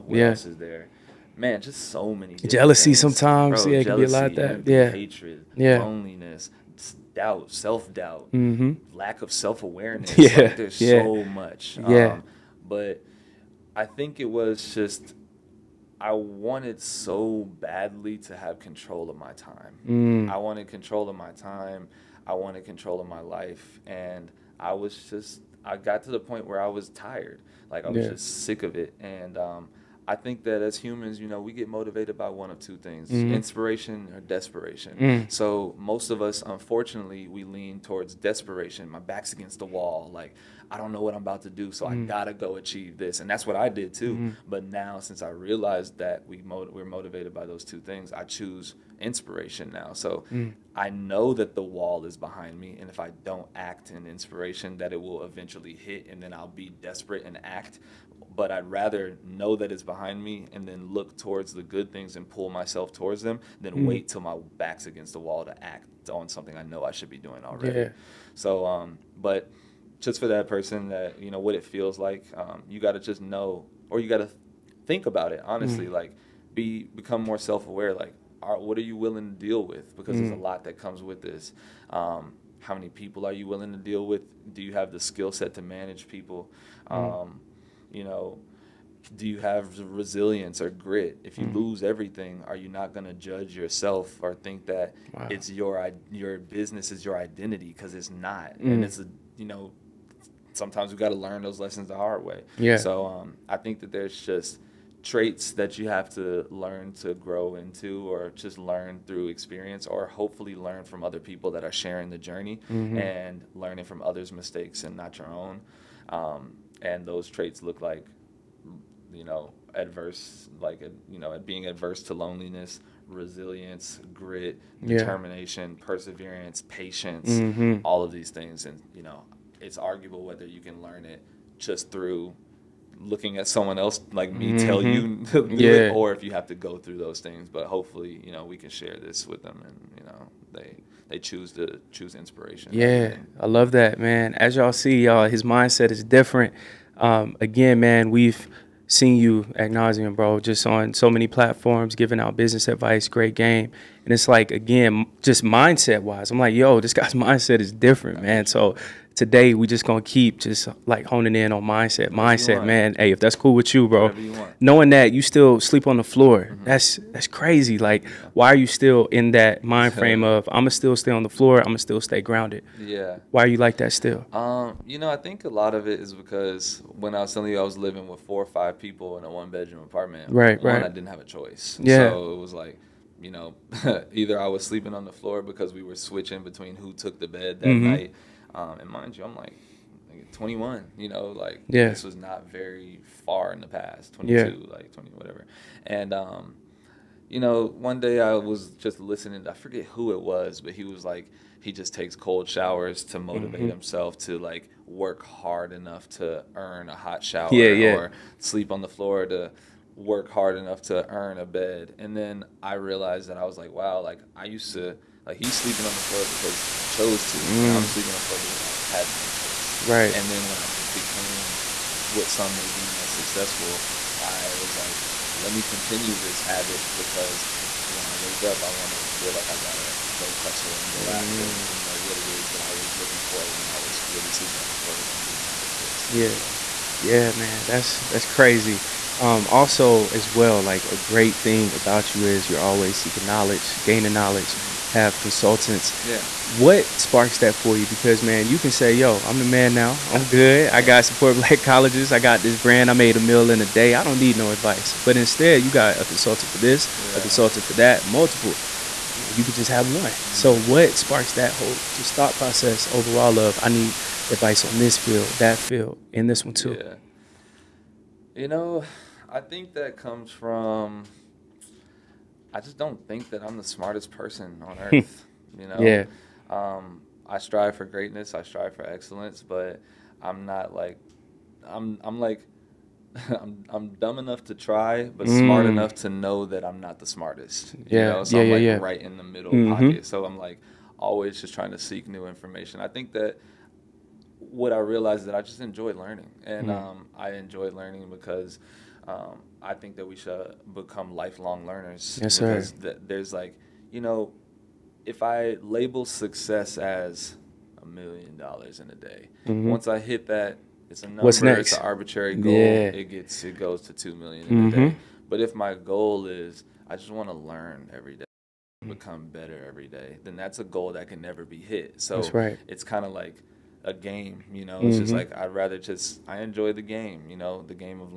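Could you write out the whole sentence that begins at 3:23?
himself to like work hard enough to earn a hot shower yeah, yeah.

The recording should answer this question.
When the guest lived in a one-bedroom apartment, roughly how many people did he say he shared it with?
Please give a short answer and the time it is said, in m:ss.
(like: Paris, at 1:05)
4 or 5, at 2:58.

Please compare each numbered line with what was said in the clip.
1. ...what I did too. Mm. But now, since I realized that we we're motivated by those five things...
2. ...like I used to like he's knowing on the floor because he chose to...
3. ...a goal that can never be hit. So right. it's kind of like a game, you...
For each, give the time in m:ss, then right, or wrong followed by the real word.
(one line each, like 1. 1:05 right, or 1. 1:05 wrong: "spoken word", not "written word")
1. 0:43 wrong: "two", not "five"
2. 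3:34 wrong: "sleeping", not "knowing"
3. 5:20 right.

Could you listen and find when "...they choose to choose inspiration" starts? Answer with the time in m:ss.
2:21.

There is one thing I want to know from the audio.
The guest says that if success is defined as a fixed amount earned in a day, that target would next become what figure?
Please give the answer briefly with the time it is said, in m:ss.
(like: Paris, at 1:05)
2 million, at 5:13.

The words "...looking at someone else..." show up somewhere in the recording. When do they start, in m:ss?
2:13.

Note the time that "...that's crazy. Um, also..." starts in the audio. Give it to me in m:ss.
3:58.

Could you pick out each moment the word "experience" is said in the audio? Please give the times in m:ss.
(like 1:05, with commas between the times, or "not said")
1:49.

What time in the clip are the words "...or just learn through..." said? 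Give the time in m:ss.
1:48.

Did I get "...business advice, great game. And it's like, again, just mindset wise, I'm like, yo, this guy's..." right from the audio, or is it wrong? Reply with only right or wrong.
right.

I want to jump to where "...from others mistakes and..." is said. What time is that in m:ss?
1:53.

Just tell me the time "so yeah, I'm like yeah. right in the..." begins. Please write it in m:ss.
4:48.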